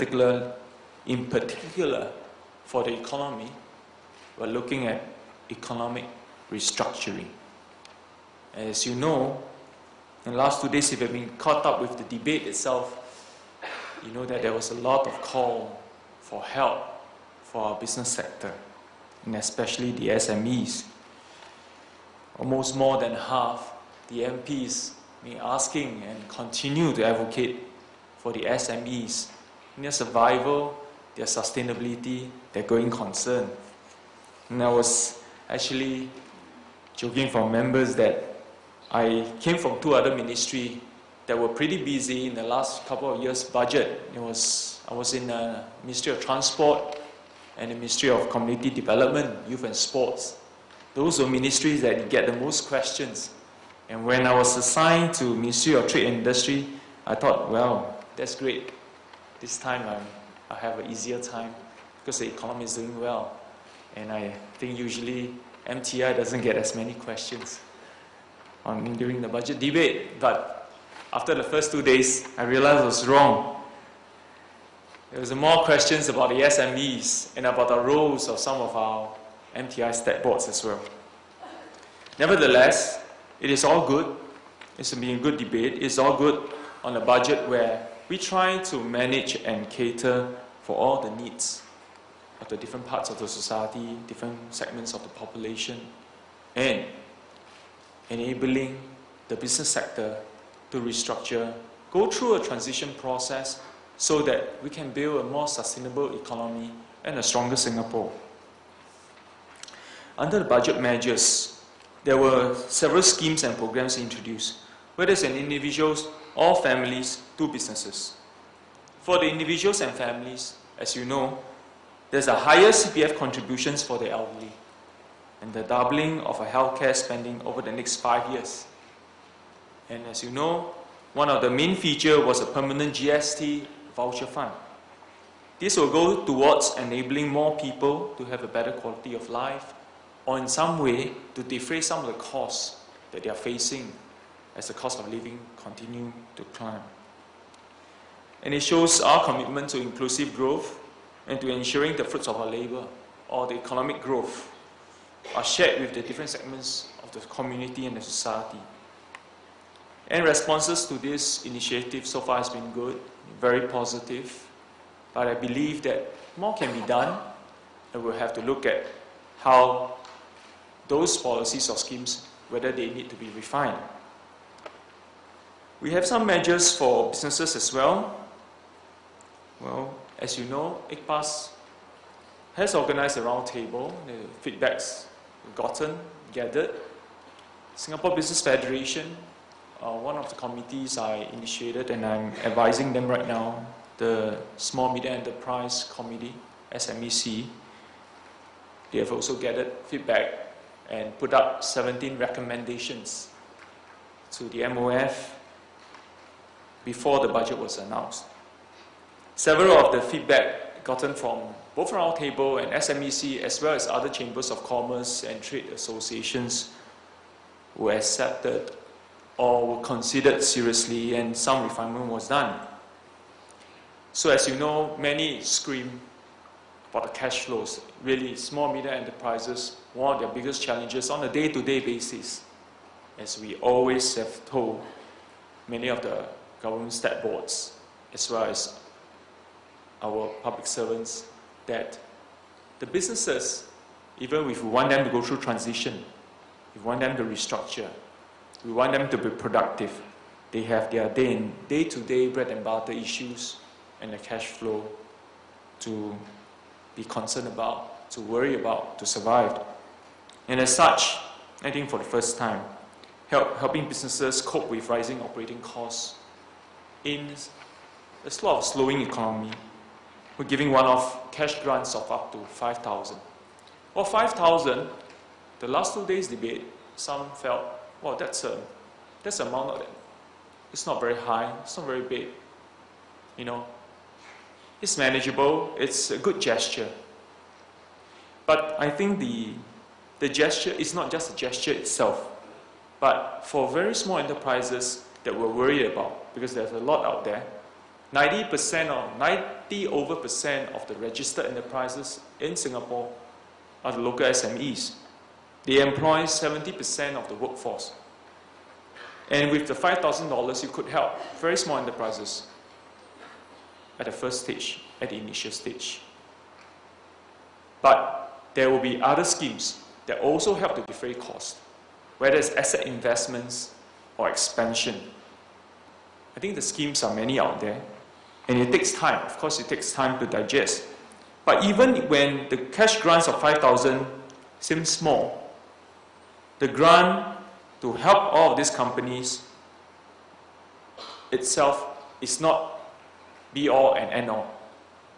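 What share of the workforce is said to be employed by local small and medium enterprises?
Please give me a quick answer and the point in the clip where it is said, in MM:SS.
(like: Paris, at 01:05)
70%, at 05:06.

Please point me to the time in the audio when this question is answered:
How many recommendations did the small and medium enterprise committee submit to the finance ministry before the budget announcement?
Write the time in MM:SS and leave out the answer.
03:21.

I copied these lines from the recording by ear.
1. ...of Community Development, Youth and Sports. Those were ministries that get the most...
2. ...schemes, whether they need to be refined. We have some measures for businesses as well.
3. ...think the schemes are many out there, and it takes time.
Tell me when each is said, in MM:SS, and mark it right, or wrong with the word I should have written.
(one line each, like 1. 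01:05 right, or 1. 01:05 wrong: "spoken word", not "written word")
1. 00:48 right
2. 02:51 right
3. 05:26 right.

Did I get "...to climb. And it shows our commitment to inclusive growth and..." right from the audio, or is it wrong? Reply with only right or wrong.
right.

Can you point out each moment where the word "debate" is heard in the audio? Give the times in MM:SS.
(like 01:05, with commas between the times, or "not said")
00:12, 01:09, 01:25, 04:36.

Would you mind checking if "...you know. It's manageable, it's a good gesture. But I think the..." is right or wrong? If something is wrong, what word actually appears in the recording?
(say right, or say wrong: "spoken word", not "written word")
right.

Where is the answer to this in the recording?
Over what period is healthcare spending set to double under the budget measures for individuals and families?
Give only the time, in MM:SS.
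02:07.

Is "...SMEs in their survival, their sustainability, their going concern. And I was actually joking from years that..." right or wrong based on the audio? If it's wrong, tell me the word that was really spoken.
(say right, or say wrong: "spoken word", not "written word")
wrong: "members", not "years".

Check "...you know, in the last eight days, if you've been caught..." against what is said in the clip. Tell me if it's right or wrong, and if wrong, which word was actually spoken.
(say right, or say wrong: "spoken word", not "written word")
wrong: "two", not "eight".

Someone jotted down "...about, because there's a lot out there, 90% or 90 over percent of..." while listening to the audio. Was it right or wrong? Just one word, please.
right.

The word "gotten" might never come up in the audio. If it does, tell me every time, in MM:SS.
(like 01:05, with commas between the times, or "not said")
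03:05, 03:30.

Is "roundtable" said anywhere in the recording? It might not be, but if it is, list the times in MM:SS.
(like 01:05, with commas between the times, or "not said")
03:03, 03:31.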